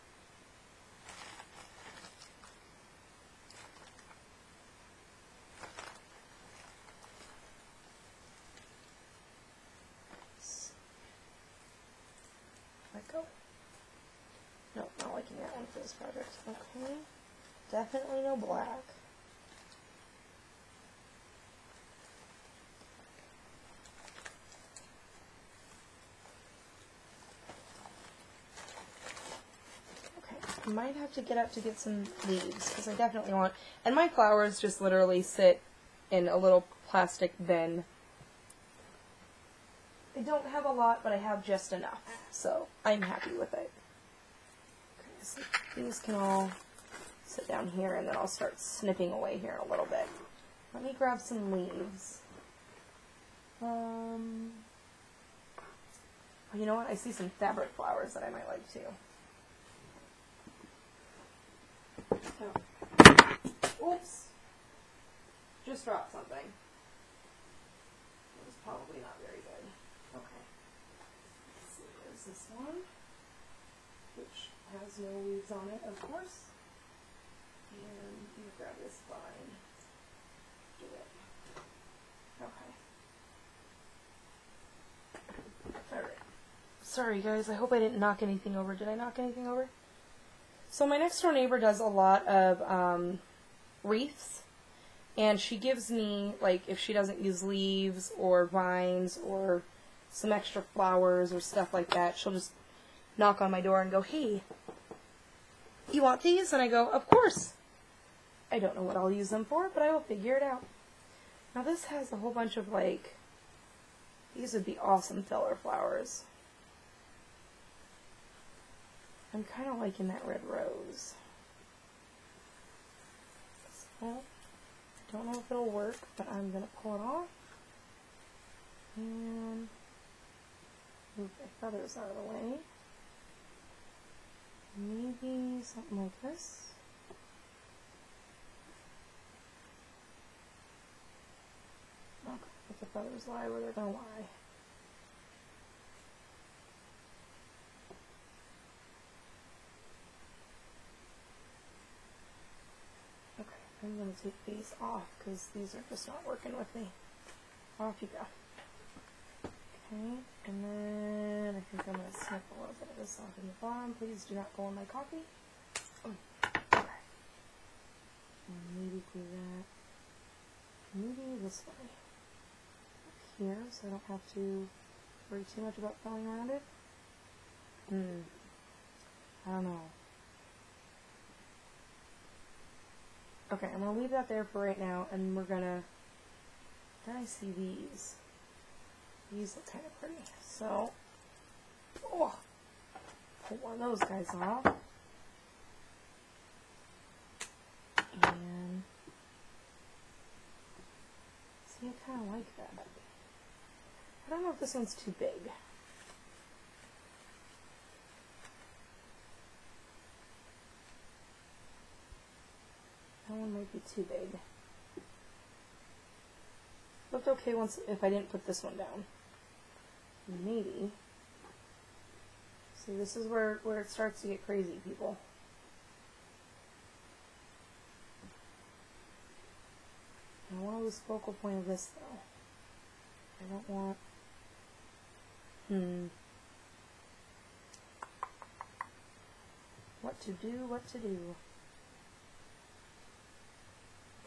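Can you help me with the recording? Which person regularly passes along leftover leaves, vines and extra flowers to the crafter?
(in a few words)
Next door neighbor.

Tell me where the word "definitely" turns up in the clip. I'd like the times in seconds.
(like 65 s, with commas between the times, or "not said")
17 s, 32 s.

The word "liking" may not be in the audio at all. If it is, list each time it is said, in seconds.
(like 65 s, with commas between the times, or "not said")
15 s, 119 s.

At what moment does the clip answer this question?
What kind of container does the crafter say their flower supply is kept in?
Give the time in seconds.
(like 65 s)
36 s.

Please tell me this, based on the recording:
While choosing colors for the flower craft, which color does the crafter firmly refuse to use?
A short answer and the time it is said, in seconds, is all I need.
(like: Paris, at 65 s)
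Black, at 18 s.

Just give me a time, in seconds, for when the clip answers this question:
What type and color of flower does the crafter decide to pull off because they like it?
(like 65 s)
120 s.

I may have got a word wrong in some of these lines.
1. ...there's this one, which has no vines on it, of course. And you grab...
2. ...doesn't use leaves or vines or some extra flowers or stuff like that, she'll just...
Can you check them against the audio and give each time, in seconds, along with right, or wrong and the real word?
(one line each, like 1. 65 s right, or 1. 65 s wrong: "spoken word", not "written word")
1. 72 s wrong: "leaves", not "vines"
2. 96 s right.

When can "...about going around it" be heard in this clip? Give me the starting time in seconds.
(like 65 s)
175 s.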